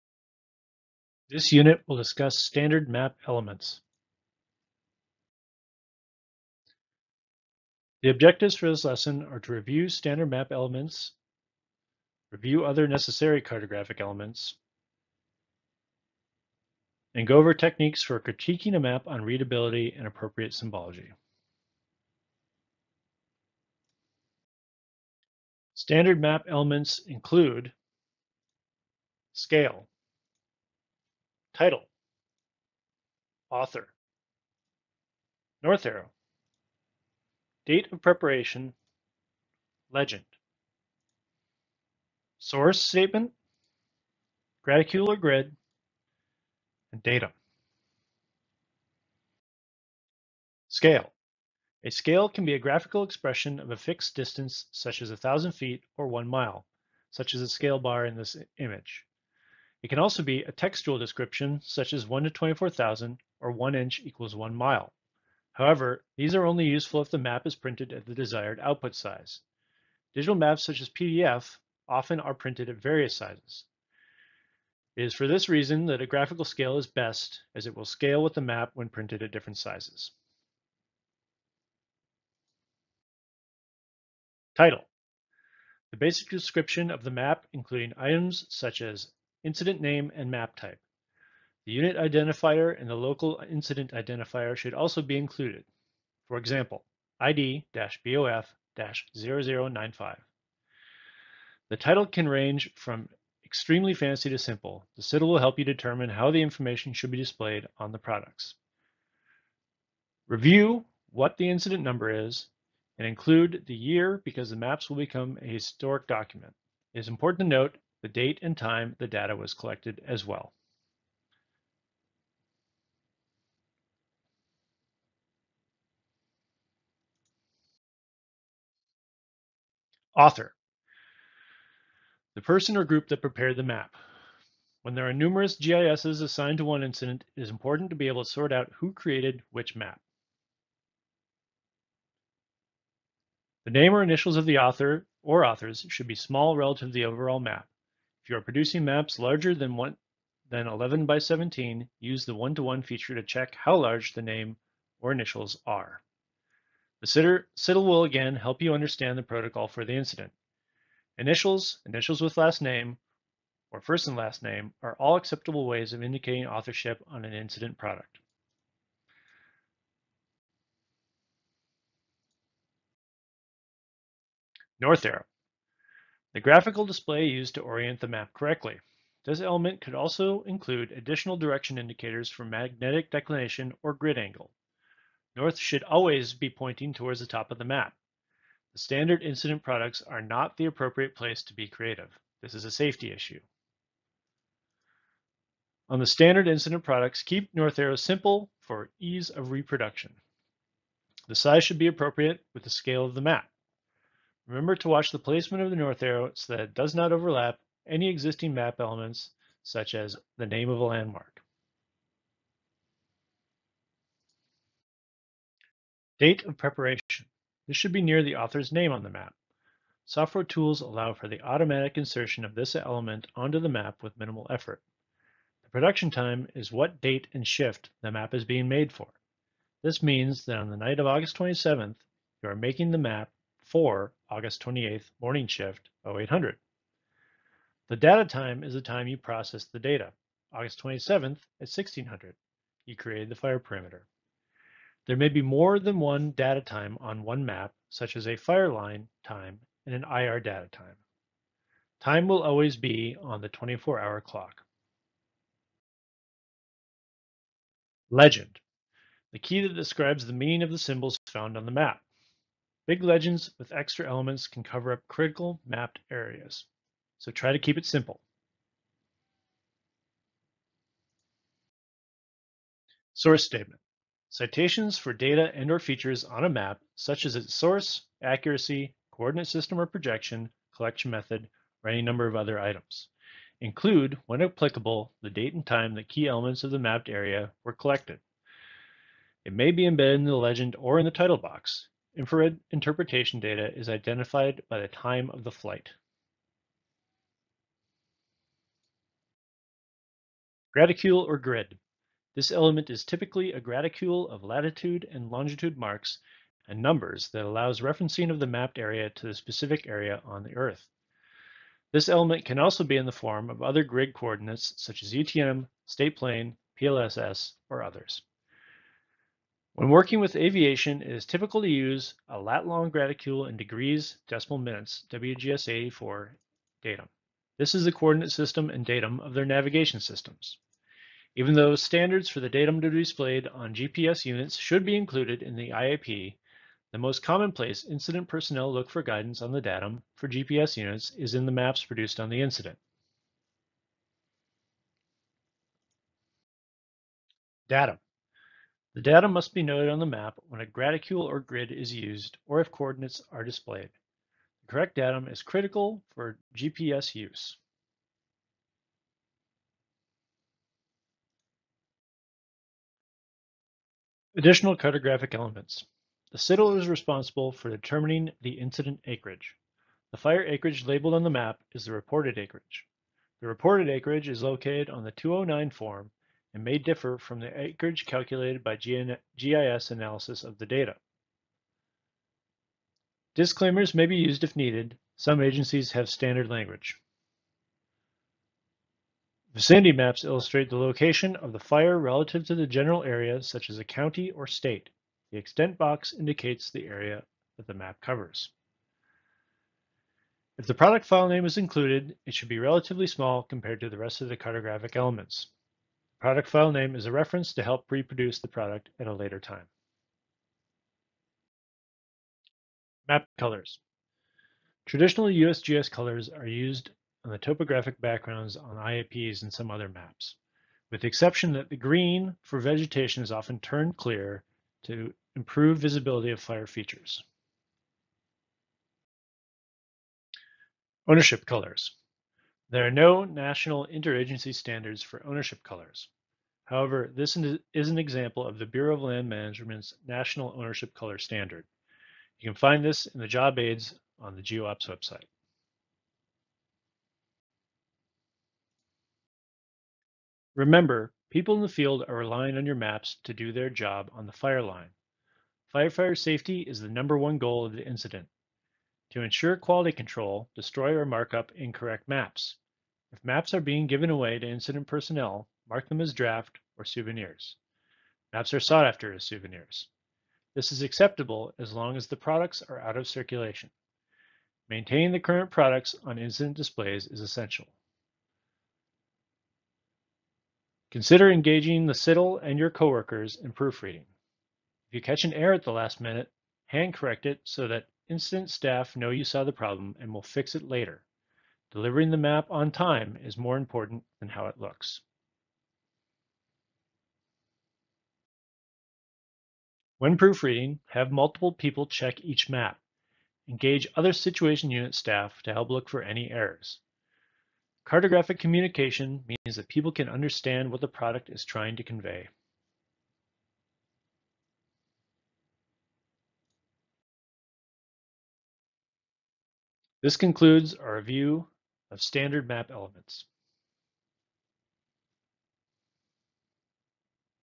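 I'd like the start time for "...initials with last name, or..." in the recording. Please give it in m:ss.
2:41.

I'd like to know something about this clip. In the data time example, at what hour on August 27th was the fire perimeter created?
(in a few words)
1600.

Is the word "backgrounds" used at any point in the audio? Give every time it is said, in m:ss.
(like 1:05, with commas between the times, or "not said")
6:57.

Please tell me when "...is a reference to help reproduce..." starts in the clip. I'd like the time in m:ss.
6:46.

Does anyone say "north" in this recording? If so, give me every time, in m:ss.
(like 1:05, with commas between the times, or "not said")
0:35, 2:54, 3:05, 3:17, 3:25.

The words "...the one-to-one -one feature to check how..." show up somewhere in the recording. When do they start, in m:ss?
2:32.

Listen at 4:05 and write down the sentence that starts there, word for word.
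There may be more than one data time on one map, such as a fire line time and an IR data time.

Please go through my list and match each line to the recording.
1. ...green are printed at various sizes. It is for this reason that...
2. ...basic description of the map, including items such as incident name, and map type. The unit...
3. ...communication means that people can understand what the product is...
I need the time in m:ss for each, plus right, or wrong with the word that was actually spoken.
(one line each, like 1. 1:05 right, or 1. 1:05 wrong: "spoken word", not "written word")
1. 1:11 wrong: "often", not "green"
2. 1:25 right
3. 8:28 right.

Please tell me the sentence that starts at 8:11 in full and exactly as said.
Delivering the map on time is more important than how it looks.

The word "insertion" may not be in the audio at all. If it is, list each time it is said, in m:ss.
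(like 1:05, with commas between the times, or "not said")
3:41.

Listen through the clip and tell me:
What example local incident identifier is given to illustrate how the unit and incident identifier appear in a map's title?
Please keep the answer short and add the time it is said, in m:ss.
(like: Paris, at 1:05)
ID-BOF-0095, at 1:37.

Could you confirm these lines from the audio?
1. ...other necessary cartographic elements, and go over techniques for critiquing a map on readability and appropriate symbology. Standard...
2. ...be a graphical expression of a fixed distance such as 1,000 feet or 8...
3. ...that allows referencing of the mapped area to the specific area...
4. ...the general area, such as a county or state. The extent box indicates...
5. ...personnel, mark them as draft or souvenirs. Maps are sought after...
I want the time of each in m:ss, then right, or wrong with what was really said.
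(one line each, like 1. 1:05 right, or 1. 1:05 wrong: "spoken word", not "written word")
1. 0:12 right
2. 0:52 wrong: "1", not "8"
3. 5:07 right
4. 6:32 right
5. 7:44 right.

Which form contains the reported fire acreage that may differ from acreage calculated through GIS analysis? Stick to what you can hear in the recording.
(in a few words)
209 form.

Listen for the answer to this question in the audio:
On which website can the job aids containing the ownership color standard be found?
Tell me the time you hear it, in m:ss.
7:24.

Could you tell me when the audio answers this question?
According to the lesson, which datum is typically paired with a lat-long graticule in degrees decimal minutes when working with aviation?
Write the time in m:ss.
5:25.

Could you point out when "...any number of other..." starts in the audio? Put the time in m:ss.
4:41.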